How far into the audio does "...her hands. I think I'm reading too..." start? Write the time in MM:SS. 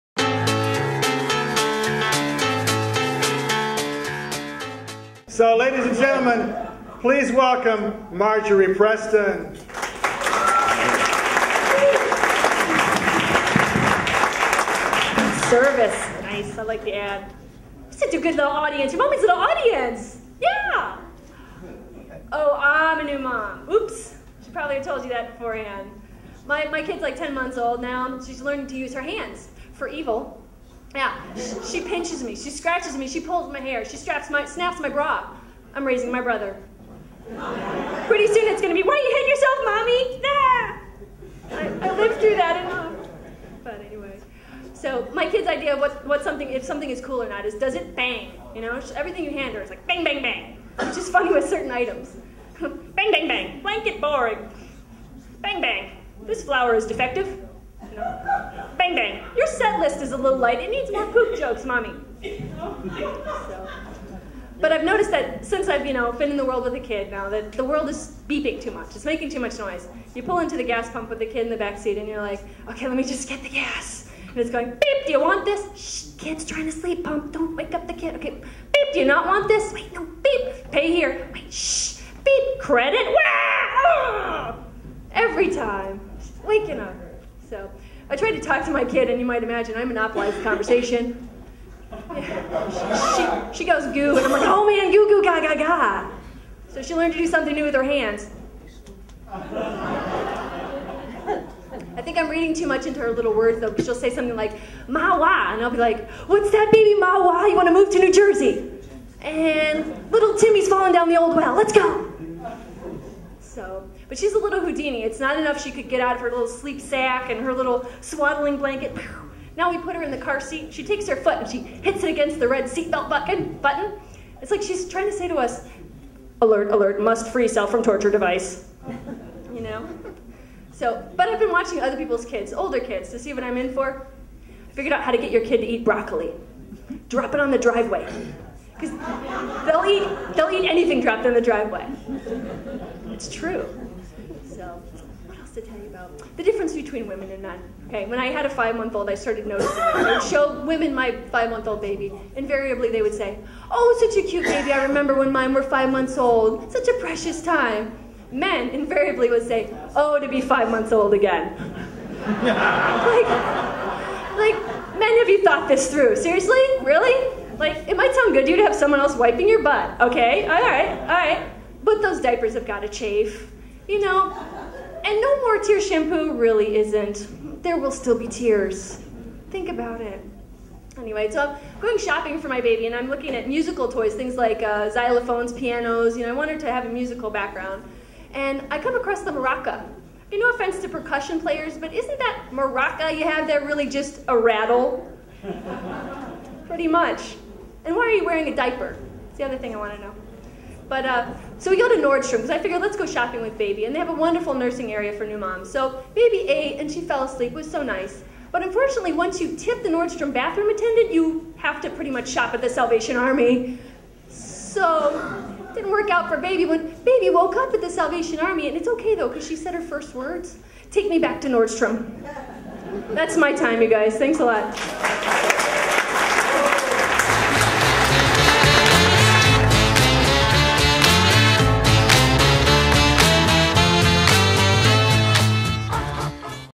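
01:37.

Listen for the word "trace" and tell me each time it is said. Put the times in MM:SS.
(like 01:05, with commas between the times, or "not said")
not said.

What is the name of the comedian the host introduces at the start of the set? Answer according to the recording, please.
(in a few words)
Marjorie Preston.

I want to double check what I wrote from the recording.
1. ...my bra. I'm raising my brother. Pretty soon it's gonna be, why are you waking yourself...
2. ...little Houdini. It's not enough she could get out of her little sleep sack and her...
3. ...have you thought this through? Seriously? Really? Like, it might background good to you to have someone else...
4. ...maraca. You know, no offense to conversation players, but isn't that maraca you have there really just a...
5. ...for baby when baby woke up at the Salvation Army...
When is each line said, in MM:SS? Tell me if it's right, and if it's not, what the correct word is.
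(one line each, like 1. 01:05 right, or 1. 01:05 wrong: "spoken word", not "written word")
1. 00:34 wrong: "hitting", not "waking"
2. 01:54 right
3. 02:45 wrong: "sound", not "background"
4. 03:09 wrong: "percussion", not "conversation"
5. 03:36 right.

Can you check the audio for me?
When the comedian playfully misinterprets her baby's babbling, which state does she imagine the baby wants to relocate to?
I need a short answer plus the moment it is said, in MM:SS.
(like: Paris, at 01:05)
New Jersey, at 01:47.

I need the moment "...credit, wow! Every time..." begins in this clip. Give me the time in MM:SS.
01:22.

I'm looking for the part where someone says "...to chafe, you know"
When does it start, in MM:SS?
02:52.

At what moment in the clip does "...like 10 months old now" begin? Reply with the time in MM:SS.
00:27.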